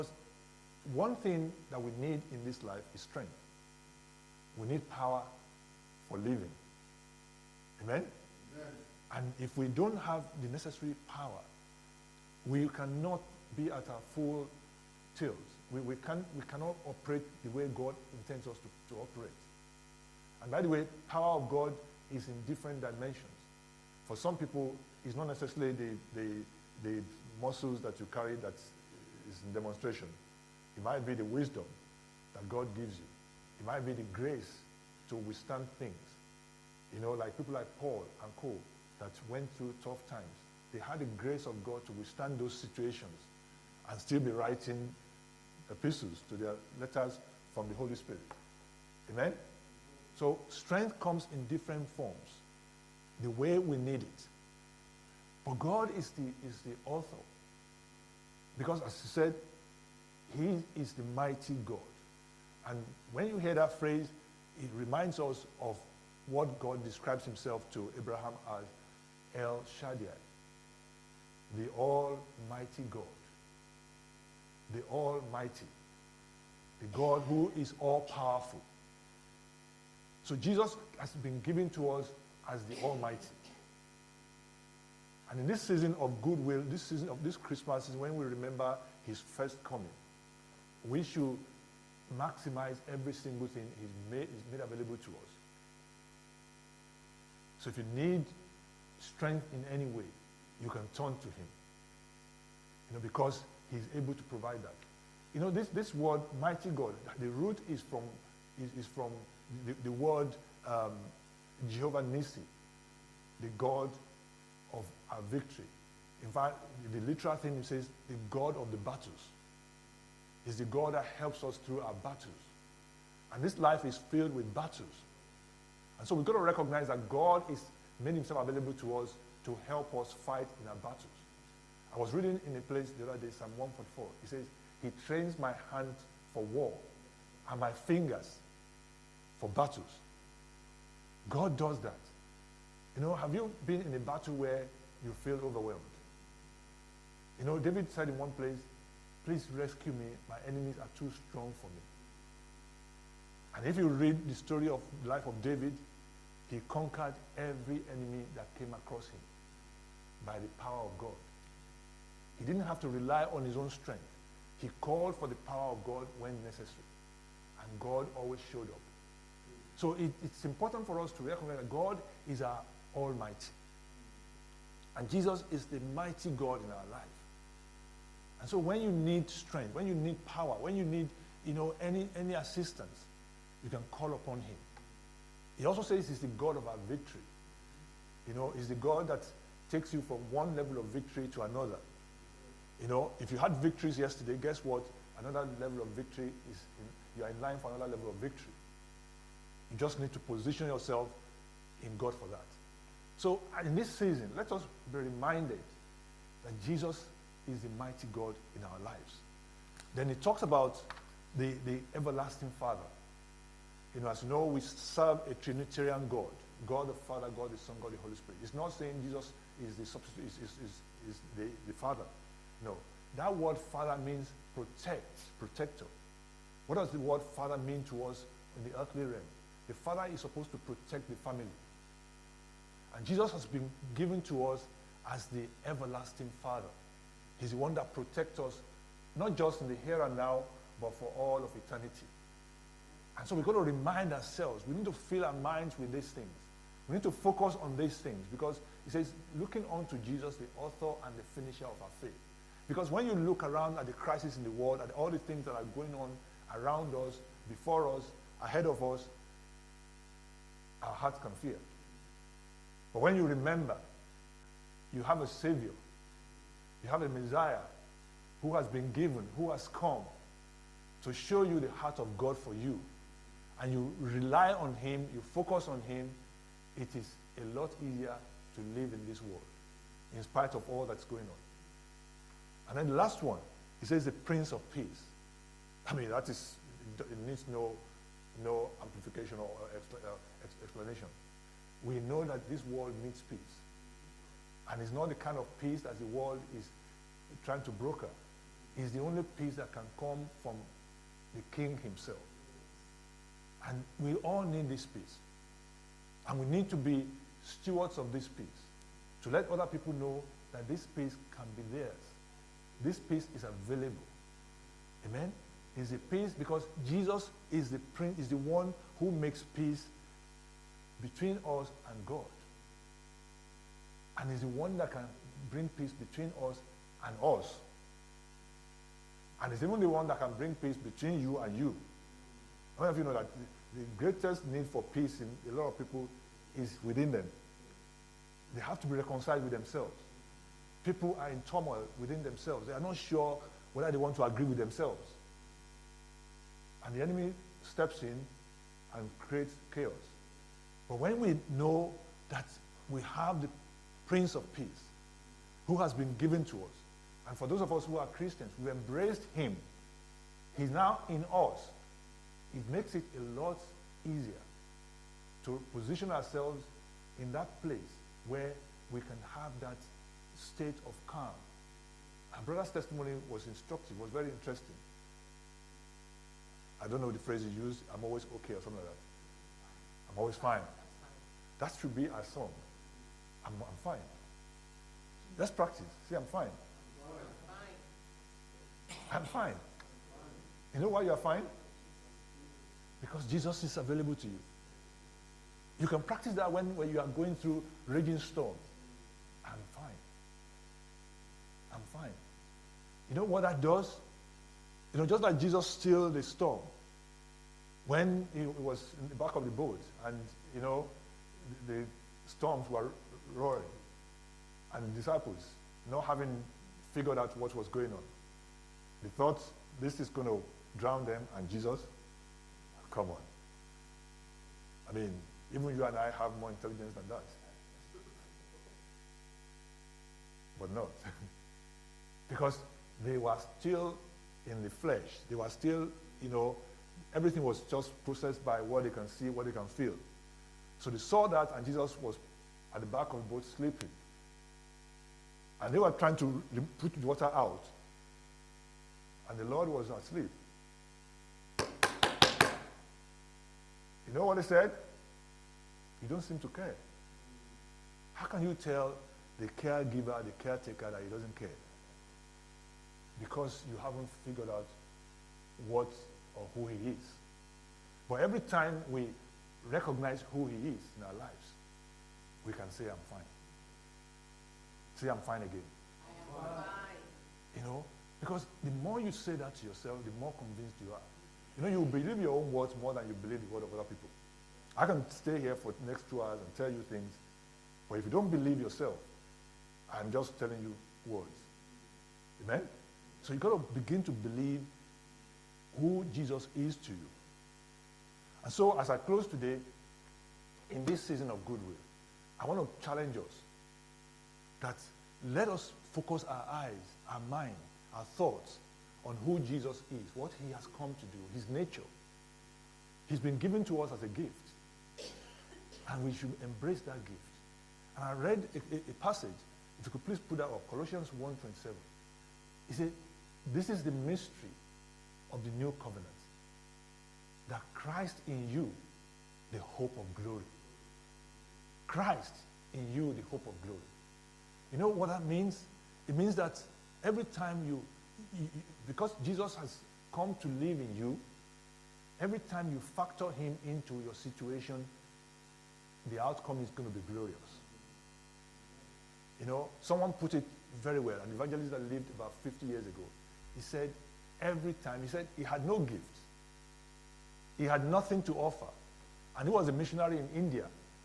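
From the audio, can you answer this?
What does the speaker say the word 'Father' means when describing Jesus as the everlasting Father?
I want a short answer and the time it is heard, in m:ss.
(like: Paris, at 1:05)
Protector, at 3:45.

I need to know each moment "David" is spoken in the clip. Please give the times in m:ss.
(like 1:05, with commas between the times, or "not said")
2:27, 2:35.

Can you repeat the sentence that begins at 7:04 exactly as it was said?
I mean, even you and I have more intelligence than that.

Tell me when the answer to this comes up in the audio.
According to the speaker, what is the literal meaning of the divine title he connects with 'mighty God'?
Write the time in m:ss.
1:58.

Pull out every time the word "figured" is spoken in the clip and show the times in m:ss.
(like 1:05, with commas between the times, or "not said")
6:56, 7:44.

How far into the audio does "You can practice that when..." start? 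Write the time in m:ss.
6:35.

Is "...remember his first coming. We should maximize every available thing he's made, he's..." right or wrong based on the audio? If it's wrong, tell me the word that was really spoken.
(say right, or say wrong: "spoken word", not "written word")
wrong: "single", not "available".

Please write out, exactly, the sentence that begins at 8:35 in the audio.
And we should embrace that gift.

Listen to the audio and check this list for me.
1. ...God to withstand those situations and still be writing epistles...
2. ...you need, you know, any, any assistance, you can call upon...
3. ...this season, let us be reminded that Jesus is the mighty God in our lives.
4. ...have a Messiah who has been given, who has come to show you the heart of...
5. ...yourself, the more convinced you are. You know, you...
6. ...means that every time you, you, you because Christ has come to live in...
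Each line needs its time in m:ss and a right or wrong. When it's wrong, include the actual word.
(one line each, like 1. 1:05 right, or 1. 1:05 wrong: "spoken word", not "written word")
1. 0:41 right
2. 3:00 right
3. 3:23 right
4. 4:26 right
5. 7:59 right
6. 8:56 wrong: "Jesus", not "Christ".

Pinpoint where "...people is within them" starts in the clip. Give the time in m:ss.
5:35.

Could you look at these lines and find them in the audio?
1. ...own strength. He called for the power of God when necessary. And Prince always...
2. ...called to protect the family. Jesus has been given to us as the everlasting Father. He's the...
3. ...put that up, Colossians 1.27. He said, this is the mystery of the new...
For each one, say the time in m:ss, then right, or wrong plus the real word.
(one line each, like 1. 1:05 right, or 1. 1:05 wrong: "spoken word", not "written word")
1. 2:43 wrong: "God", not "Prince"
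2. 3:50 wrong: "supposed", not "called"
3. 8:40 right.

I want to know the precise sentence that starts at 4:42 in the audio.
And then the last one, he says the Prince of Peace.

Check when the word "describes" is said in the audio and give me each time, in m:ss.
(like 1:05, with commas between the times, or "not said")
1:06.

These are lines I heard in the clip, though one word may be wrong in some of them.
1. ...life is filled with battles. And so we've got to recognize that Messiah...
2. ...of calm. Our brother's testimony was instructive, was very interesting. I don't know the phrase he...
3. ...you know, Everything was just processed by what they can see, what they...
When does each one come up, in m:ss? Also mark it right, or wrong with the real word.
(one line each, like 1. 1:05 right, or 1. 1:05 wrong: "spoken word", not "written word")
1. 2:03 wrong: "God", not "Messiah"
2. 6:10 right
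3. 7:16 right.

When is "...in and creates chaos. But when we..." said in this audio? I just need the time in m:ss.
5:48.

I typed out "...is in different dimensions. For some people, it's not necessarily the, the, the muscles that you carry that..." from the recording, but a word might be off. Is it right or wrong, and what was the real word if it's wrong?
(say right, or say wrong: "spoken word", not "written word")
right.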